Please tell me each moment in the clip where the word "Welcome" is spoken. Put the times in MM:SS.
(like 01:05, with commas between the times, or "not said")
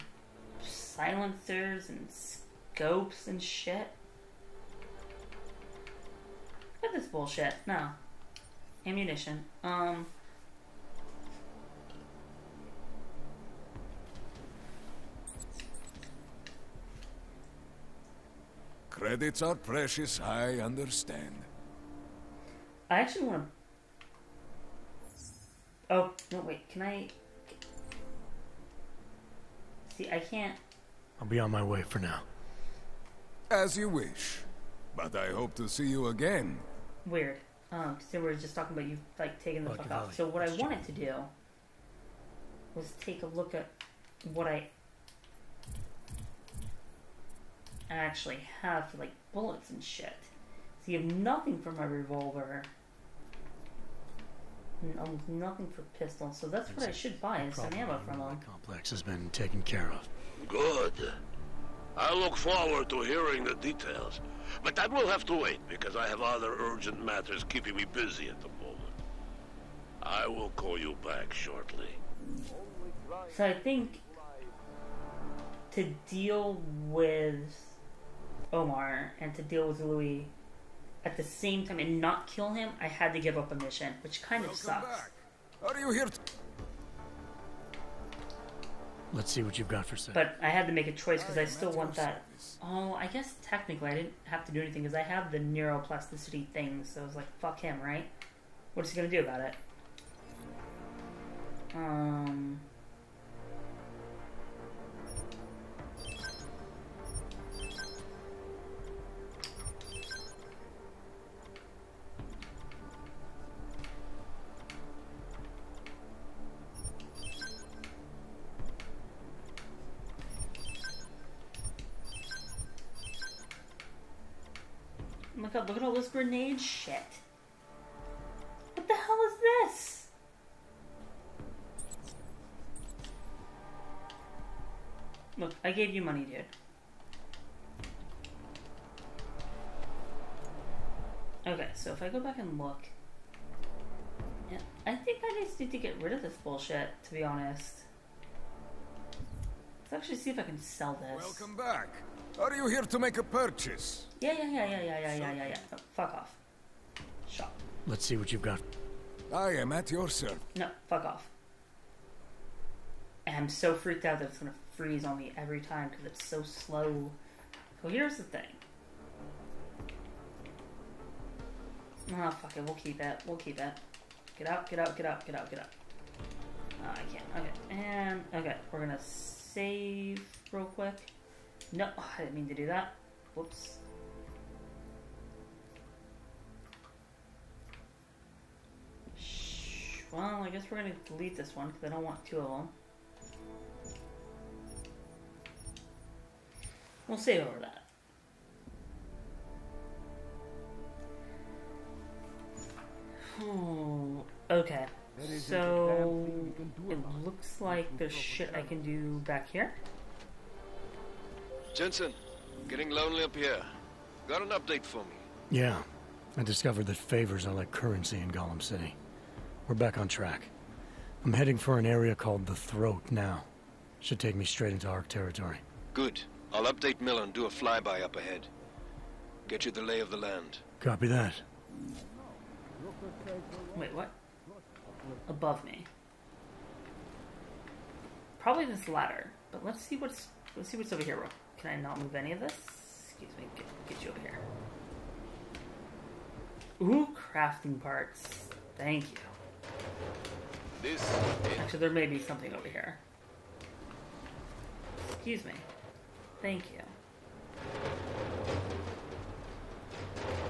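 01:24, 02:31.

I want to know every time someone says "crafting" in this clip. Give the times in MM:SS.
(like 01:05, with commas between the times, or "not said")
04:07.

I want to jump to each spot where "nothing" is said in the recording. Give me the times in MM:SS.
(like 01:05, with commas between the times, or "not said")
00:51, 00:55.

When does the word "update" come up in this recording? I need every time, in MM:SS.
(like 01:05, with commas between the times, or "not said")
03:34, 03:46.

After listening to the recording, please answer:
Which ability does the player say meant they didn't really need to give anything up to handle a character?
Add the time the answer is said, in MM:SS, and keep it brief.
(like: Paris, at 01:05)
Neuroplasticity, at 01:35.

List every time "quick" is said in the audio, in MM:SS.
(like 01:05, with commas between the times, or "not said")
03:00.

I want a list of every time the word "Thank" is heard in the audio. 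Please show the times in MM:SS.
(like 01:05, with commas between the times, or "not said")
04:08, 04:16.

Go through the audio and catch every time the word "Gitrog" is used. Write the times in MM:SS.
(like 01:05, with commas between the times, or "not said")
not said.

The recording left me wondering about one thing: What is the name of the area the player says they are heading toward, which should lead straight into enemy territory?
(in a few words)
The Throat.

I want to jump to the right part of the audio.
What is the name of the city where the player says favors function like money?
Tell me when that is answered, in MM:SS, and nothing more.
03:38.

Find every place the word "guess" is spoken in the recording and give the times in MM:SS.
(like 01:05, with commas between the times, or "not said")
01:33, 03:10.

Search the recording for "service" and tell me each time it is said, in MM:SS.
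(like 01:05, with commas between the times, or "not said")
01:32, 02:40.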